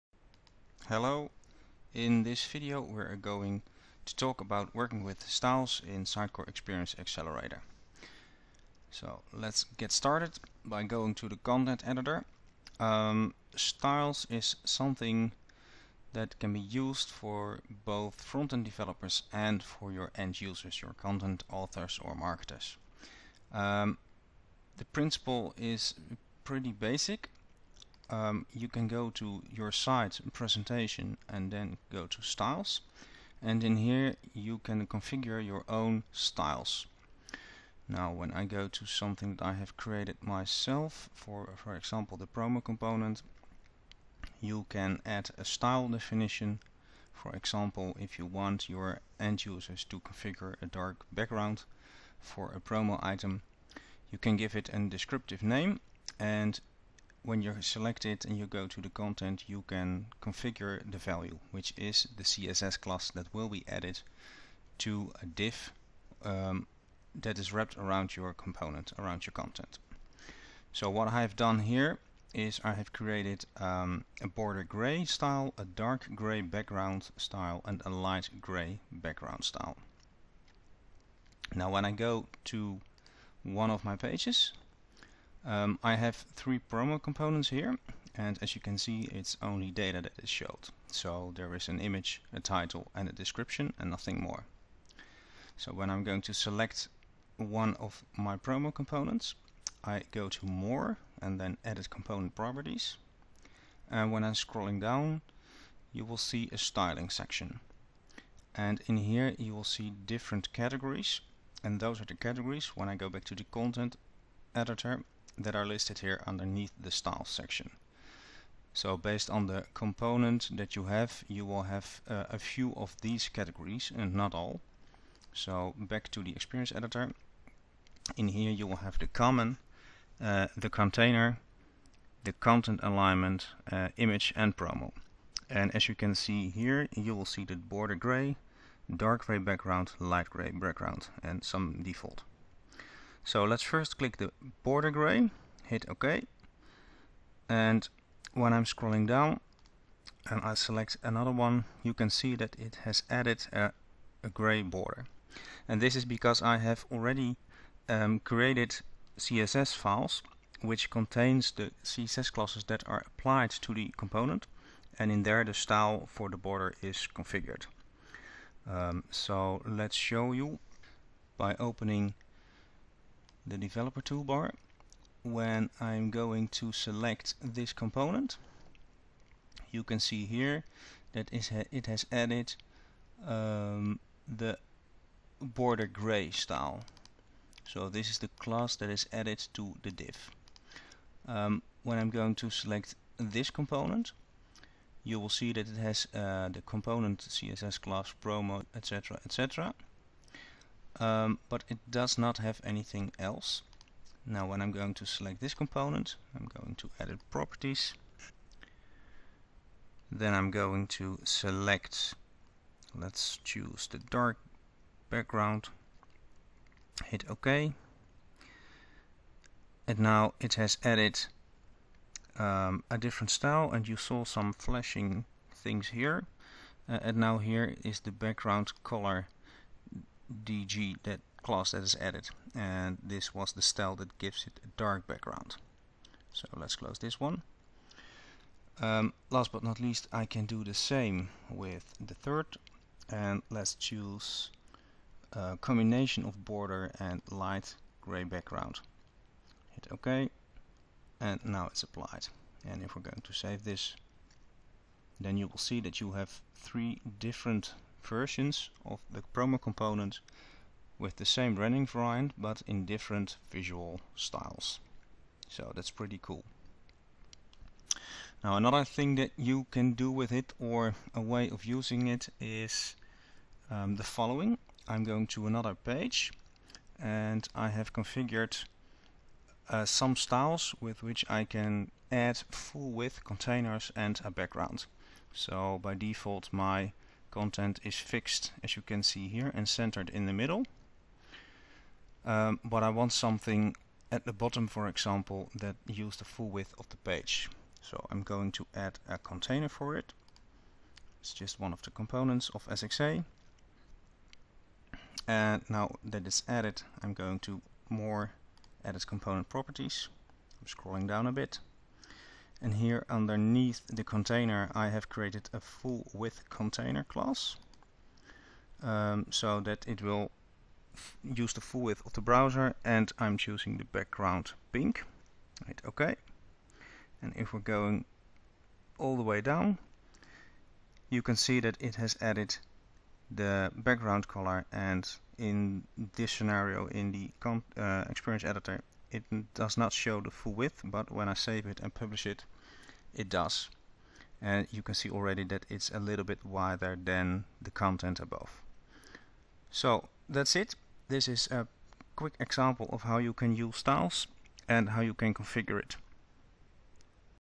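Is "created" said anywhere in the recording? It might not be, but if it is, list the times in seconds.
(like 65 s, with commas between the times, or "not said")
39 s, 72 s, 158 s, 315 s.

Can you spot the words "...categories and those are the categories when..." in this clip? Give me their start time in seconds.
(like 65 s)
110 s.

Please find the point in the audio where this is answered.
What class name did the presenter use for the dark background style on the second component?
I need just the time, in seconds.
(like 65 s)
228 s.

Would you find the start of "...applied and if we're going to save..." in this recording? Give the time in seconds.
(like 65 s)
251 s.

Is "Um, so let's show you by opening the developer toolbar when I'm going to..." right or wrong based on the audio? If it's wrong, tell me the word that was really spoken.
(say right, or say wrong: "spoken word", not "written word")
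right.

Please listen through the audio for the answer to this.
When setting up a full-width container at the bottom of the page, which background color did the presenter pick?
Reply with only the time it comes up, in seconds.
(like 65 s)
323 s.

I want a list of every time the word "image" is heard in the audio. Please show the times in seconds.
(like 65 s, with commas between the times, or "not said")
91 s, 133 s.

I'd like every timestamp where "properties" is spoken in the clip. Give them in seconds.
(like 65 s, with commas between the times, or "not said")
102 s, 207 s, 309 s.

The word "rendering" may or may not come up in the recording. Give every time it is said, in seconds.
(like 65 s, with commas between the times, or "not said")
261 s.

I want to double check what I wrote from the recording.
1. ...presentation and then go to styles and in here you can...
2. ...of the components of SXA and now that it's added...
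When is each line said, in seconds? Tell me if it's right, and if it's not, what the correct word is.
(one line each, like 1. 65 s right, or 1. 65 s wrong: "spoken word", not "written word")
1. 30 s right
2. 301 s right.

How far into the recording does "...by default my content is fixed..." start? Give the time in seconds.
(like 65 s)
285 s.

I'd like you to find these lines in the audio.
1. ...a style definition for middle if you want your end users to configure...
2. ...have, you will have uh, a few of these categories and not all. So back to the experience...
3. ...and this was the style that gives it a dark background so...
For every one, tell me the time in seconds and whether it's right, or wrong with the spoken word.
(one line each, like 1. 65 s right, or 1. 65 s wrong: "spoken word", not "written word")
1. 45 s wrong: "example", not "middle"
2. 120 s right
3. 232 s right.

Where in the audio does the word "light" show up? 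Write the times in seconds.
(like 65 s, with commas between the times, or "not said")
77 s, 139 s, 247 s.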